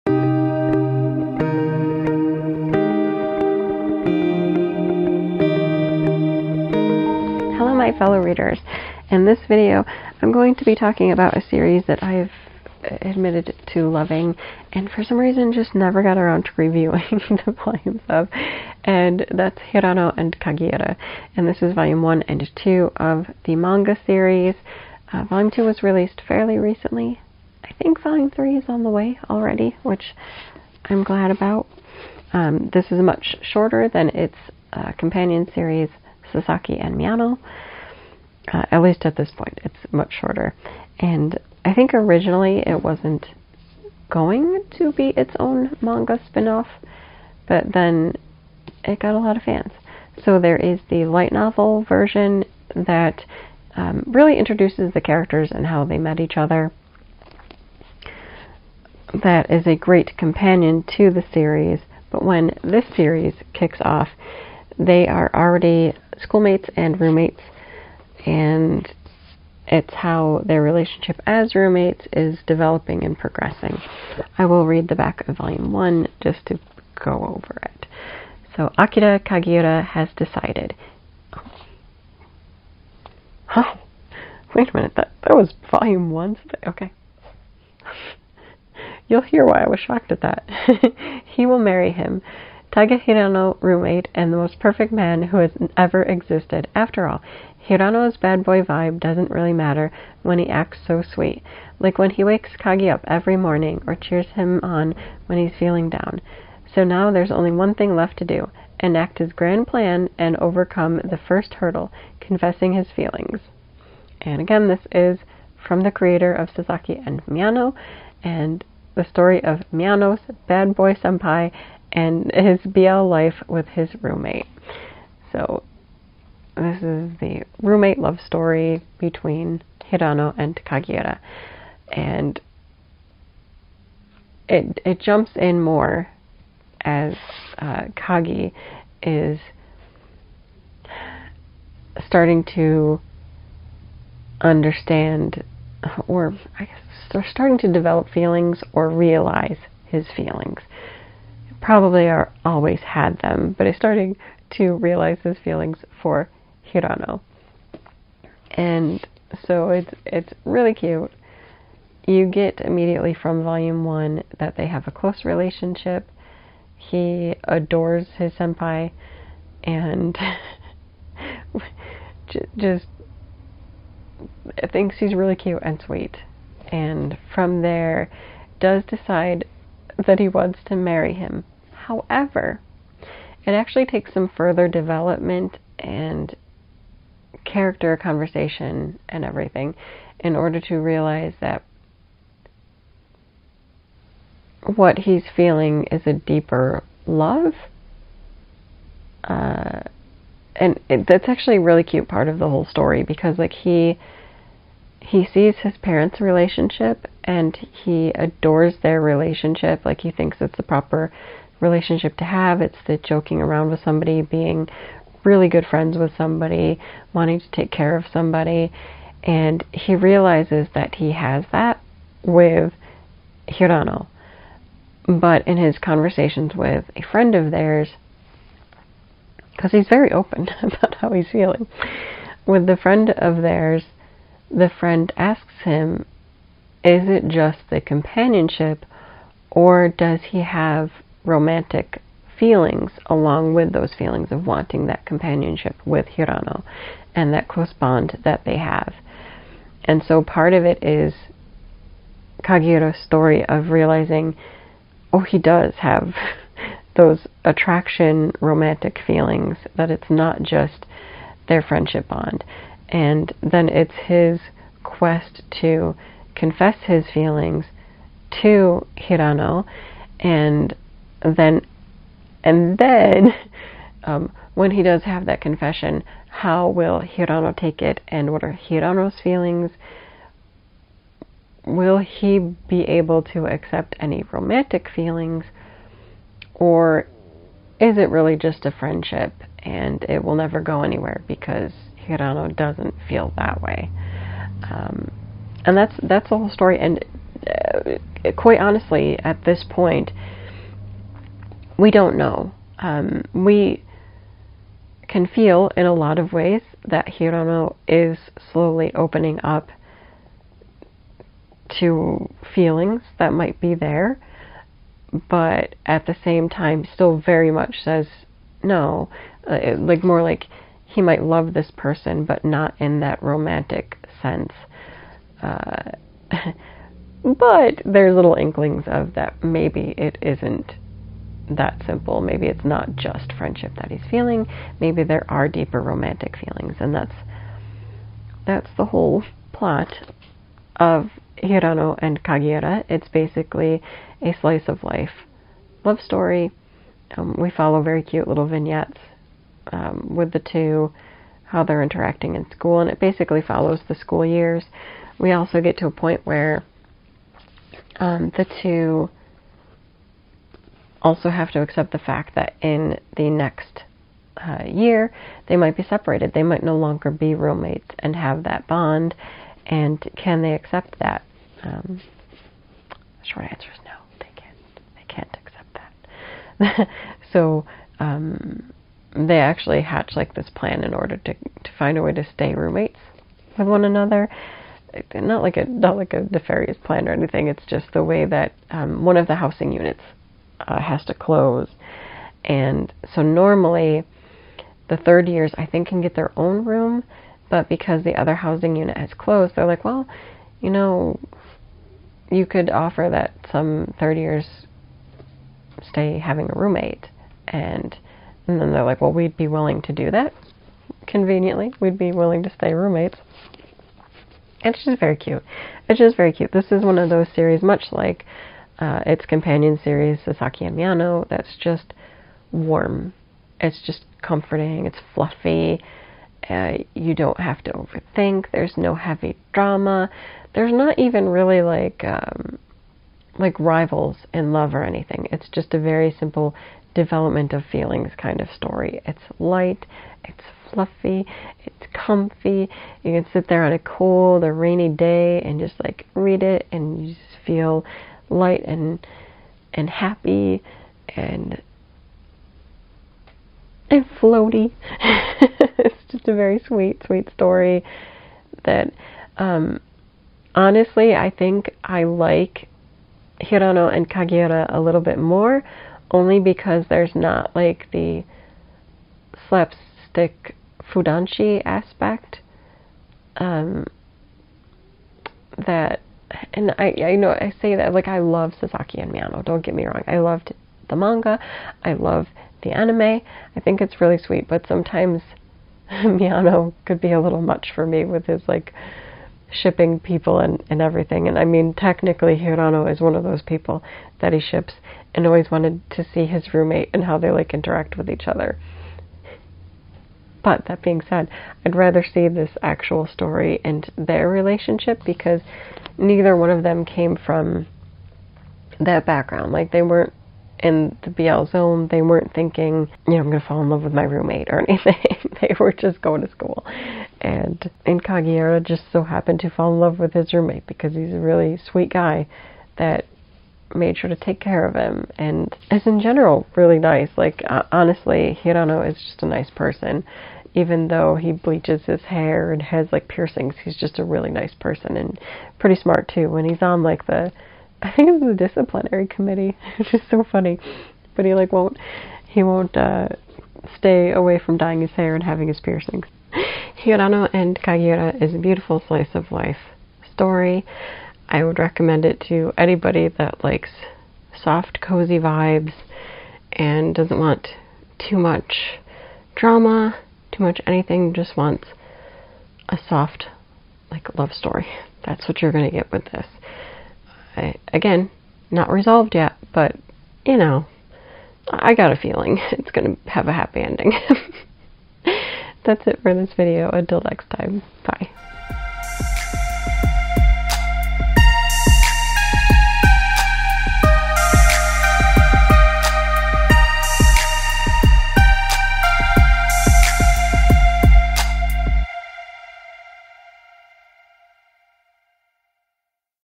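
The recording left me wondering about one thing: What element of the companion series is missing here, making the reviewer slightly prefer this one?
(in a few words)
slapstick fudanshi aspect.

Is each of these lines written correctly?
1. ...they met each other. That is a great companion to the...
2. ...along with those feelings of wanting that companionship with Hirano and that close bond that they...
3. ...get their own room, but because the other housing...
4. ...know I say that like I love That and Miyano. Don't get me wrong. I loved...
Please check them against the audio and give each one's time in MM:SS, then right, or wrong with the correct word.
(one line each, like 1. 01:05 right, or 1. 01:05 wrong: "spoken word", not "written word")
1. 00:55 right
2. 04:03 right
3. 06:36 right
4. 07:57 wrong: "Sasaki", not "That".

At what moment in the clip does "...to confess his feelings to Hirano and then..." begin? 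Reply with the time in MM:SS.
04:25.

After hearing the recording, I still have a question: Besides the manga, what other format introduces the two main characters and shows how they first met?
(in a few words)
light novel.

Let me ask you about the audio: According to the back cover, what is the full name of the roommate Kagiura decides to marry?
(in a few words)
Takahiro Hirano.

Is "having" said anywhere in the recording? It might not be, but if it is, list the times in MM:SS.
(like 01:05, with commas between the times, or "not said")
06:46, 09:05.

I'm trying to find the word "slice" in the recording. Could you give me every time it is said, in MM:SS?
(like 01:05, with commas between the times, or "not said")
05:44, 09:08.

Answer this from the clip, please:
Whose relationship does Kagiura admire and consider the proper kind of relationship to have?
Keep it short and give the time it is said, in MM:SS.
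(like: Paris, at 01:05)
his parents', at 03:25.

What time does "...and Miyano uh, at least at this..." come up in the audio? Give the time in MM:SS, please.
00:36.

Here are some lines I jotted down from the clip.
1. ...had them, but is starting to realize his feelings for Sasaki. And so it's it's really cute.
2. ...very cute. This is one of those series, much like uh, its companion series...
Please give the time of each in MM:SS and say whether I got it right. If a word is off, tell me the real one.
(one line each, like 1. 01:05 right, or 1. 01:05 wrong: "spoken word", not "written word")
1. 02:32 wrong: "Hirano", not "Sasaki"
2. 06:56 right.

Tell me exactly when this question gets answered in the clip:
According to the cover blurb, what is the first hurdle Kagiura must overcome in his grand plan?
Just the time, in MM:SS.
01:52.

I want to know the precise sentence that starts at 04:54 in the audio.
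Um, and that's that's the whole story.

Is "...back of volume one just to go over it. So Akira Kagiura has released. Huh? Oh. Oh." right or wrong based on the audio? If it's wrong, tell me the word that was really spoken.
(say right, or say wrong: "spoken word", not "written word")
wrong: "decided", not "released".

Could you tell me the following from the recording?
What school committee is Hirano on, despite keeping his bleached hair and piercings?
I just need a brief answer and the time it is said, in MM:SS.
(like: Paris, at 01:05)
disciplinary committee, at 08:58.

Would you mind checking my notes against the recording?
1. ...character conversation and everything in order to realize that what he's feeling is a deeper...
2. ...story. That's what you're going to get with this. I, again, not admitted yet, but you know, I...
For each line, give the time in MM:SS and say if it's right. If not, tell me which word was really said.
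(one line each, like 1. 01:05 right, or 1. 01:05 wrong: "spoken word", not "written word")
1. 03:07 right
2. 09:24 wrong: "resolved", not "admitted".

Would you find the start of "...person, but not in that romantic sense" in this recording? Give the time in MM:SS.
05:21.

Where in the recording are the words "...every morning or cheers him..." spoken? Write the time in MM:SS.
01:43.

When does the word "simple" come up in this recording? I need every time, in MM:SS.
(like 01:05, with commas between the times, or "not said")
05:31, 07:16.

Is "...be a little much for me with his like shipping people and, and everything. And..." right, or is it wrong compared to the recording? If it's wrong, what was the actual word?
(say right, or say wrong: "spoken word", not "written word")
right.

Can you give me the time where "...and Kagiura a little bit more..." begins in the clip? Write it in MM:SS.
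07:43.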